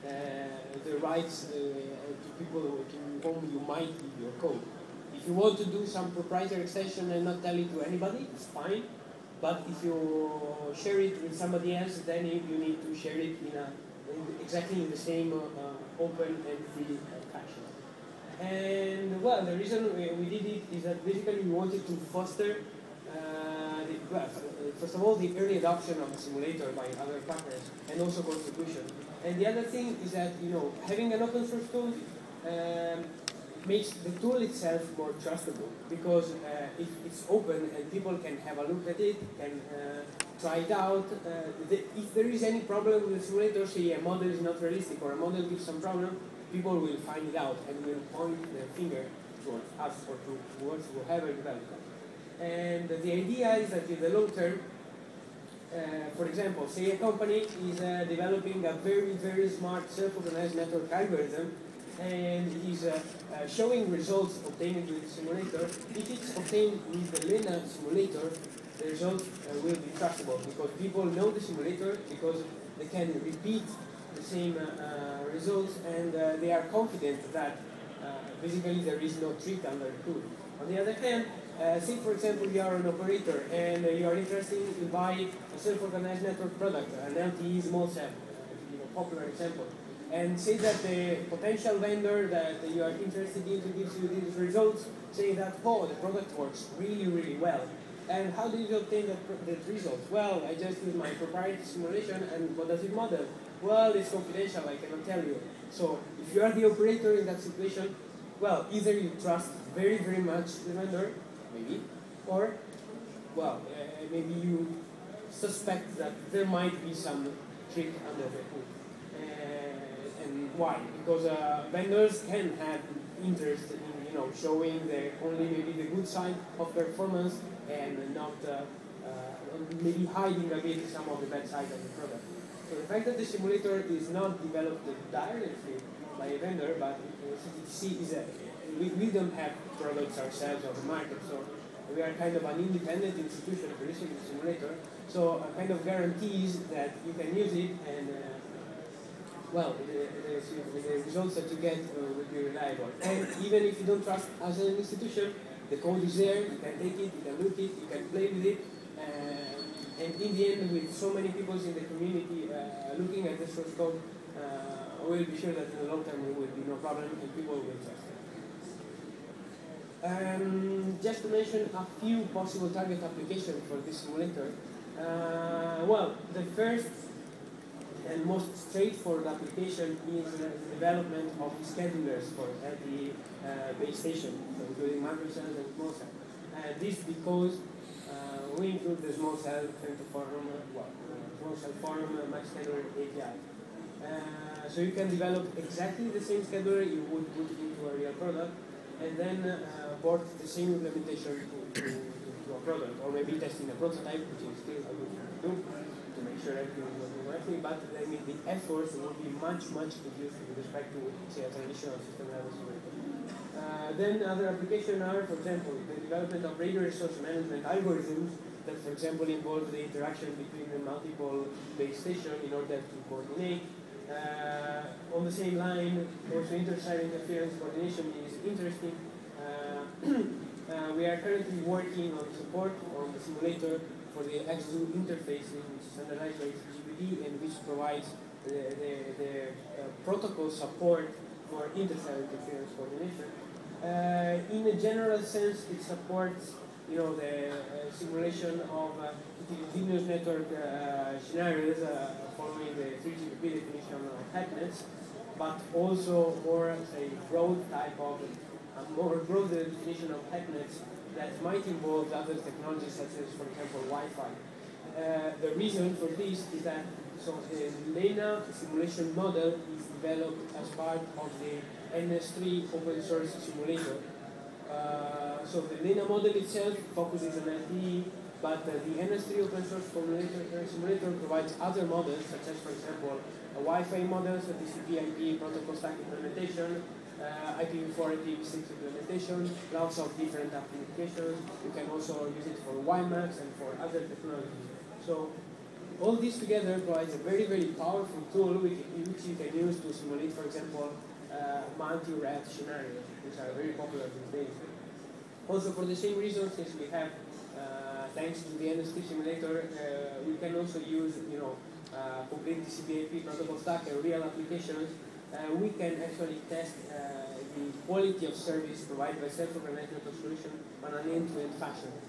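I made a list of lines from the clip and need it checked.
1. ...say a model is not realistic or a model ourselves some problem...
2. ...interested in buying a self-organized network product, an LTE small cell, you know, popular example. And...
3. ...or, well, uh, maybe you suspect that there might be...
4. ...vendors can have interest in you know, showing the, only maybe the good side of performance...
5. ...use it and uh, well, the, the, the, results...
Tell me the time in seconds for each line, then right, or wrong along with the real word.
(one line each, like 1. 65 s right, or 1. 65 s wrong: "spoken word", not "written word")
1. 43 s wrong: "gives", not "ourselves"
2. 84 s right
3. 112 s right
4. 121 s right
5. 147 s right.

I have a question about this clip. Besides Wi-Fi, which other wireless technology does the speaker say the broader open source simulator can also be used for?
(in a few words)
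WiMAX.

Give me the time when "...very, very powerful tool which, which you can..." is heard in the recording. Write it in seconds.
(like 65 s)
297 s.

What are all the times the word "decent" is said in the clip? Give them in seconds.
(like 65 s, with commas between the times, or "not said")
not said.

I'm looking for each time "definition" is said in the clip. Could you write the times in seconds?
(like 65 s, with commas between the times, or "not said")
253 s, 259 s.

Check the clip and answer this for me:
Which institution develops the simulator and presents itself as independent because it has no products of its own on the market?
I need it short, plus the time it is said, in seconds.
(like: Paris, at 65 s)
CTTC, at 137 s.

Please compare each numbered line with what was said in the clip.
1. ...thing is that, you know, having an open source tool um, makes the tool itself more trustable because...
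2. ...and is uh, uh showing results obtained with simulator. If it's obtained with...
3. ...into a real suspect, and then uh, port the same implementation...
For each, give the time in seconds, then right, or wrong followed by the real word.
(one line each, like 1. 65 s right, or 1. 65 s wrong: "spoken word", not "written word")
1. 29 s right
2. 61 s right
3. 197 s wrong: "product", not "suspect".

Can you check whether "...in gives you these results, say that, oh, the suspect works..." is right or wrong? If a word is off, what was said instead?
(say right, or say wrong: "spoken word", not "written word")
wrong: "product", not "suspect".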